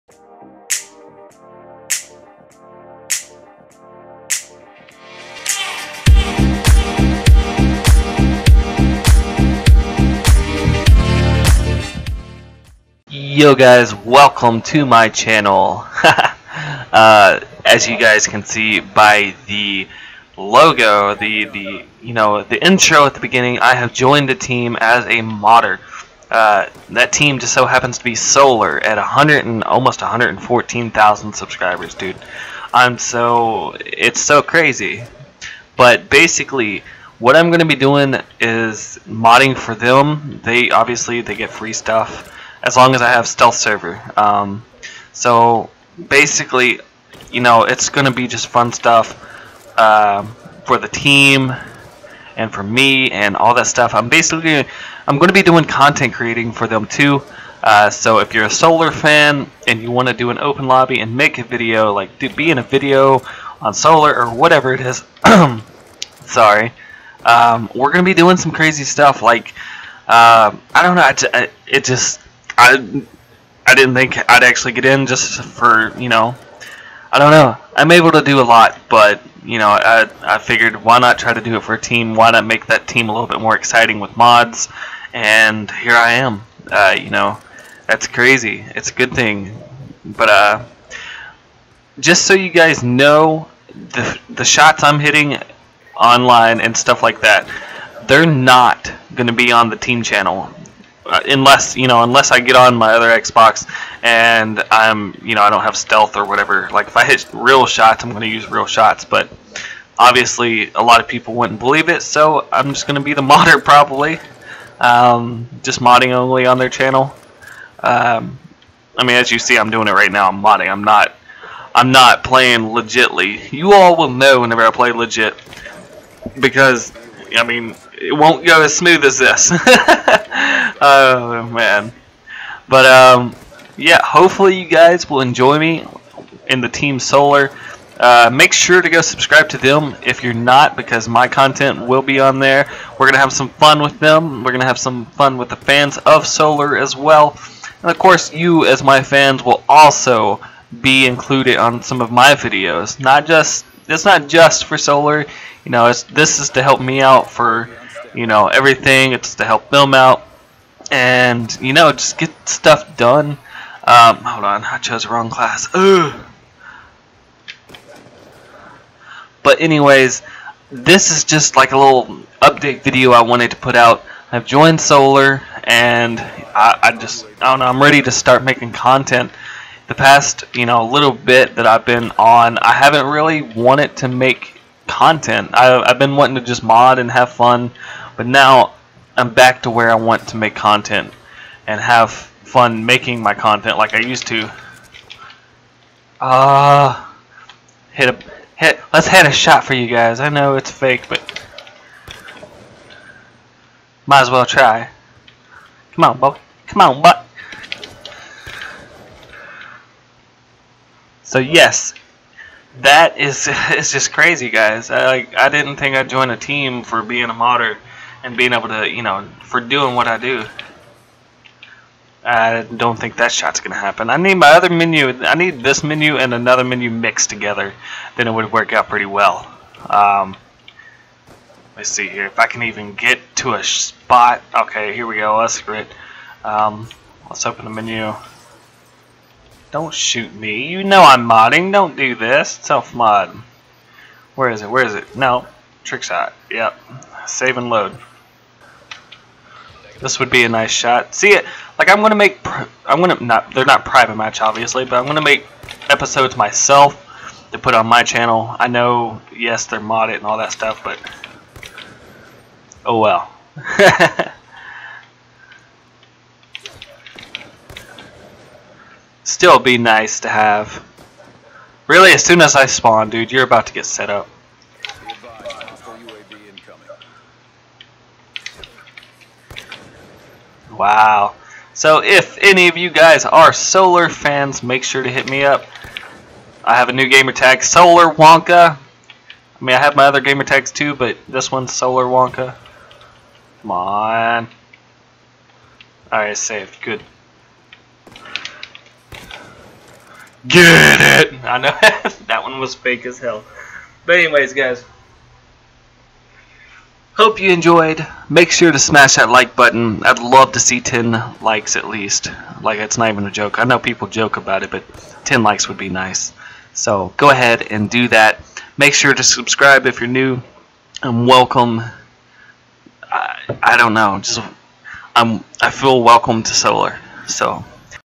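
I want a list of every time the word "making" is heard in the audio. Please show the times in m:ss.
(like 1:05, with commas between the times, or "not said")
2:58, 3:12.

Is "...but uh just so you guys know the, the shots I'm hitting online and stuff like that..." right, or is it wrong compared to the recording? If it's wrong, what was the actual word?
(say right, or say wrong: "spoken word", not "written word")
right.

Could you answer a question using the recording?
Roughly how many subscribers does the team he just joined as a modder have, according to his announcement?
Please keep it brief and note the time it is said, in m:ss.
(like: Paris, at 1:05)
114,000, at 0:30.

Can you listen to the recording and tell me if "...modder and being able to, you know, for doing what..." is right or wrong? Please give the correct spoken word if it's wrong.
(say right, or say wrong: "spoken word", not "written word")
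right.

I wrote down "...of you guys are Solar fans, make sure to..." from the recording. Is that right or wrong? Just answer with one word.
right.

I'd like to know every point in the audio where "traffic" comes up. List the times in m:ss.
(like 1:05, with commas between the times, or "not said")
not said.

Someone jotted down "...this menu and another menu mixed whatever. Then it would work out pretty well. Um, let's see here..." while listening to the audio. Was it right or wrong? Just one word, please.
wrong.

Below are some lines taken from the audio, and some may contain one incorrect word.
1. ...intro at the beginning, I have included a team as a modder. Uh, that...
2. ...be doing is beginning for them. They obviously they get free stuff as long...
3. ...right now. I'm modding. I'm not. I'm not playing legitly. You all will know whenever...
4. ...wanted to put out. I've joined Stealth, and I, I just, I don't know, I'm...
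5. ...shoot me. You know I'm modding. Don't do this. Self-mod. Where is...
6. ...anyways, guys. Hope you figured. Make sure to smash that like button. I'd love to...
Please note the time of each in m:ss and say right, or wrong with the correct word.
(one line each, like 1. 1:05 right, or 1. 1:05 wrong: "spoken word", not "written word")
1. 0:22 wrong: "joined", not "included"
2. 0:37 wrong: "modding", not "beginning"
3. 1:59 right
4. 2:53 wrong: "Solar", not "Stealth"
5. 3:59 right
6. 5:04 wrong: "enjoyed", not "figured".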